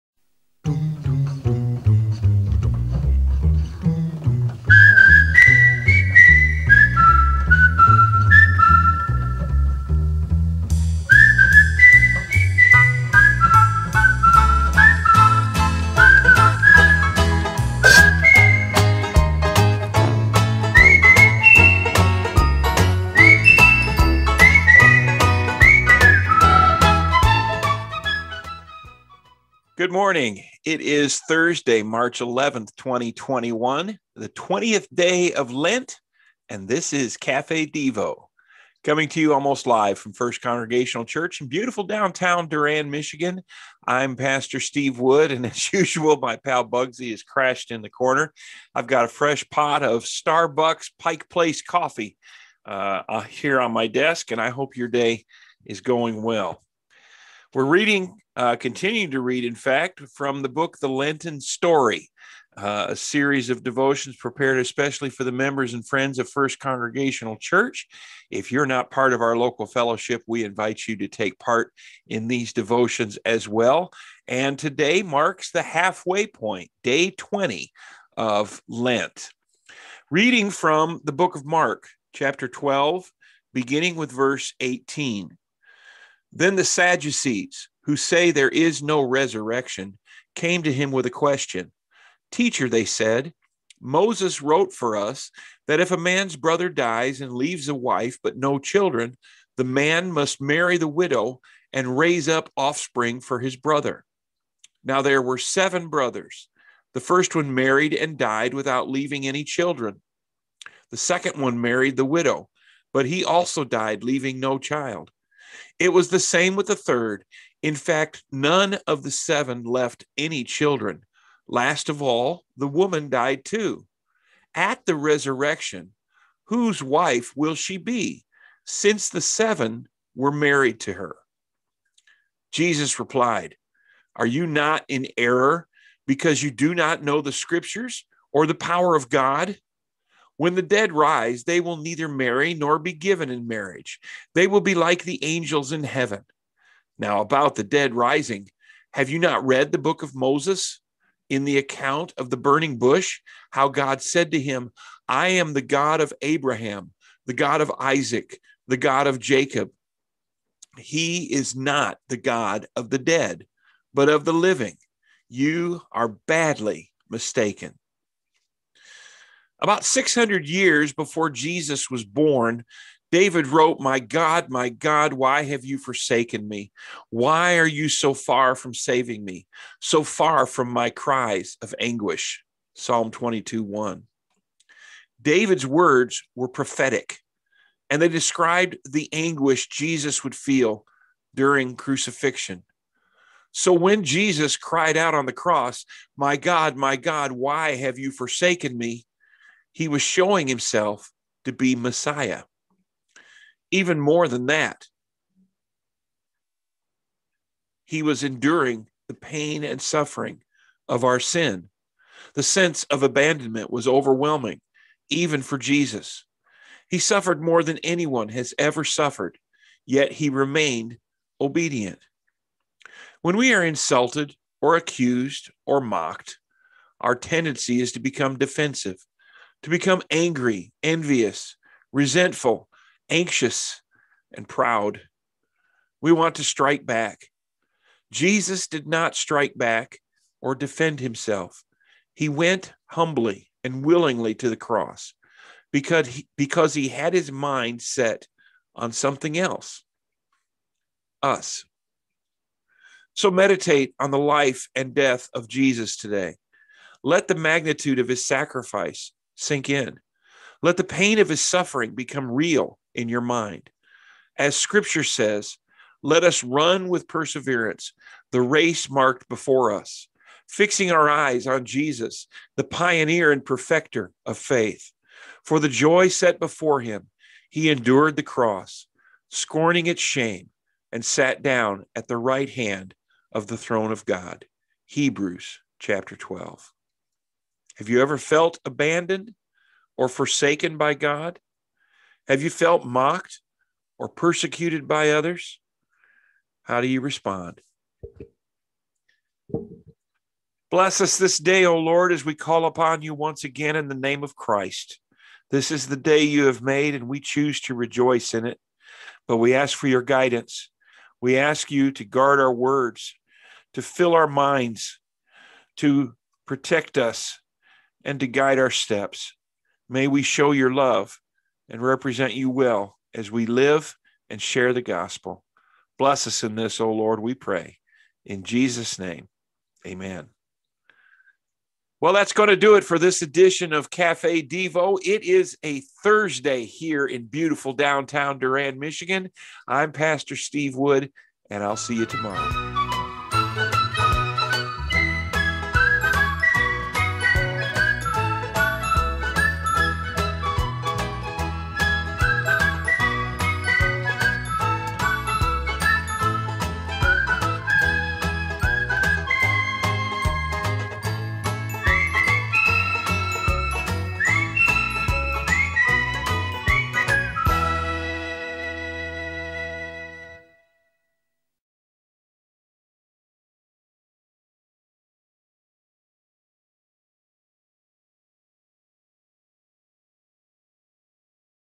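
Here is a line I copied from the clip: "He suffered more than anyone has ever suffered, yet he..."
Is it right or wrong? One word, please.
right.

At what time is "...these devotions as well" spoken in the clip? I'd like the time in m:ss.
1:12.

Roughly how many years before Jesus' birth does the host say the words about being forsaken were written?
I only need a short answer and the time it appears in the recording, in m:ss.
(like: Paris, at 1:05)
600, at 2:49.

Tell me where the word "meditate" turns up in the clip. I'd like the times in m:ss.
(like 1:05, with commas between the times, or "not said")
4:13.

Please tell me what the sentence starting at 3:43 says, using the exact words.
When we are insulted or accused or mocked, our tendency is to become defensive to become angry, envious, resentful, anxious, and proud.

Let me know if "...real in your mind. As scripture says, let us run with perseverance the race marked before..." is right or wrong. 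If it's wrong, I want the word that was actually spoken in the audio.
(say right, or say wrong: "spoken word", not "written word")
right.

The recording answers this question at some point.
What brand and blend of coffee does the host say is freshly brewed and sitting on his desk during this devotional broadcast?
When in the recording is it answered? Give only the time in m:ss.
0:50.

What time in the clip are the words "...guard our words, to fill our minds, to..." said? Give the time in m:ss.
5:12.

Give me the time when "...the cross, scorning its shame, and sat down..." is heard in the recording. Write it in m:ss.
4:38.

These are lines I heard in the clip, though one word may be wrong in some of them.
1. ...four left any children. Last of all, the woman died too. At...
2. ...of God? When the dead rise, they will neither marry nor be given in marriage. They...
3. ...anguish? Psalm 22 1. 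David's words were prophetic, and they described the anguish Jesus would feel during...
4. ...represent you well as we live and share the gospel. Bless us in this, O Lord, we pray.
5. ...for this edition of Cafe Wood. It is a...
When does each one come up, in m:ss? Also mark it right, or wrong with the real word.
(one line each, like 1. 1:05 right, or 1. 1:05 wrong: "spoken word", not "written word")
1. 1:59 wrong: "seven", not "four"
2. 2:18 right
3. 3:01 right
4. 5:21 right
5. 5:32 wrong: "Devo", not "Wood".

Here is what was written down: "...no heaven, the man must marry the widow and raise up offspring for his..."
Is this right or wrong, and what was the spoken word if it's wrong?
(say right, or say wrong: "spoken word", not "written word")
wrong: "children", not "heaven".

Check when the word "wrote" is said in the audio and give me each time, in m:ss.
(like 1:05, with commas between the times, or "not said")
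1:34, 2:53.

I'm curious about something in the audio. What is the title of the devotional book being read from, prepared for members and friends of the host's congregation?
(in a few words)
The Lenten Story.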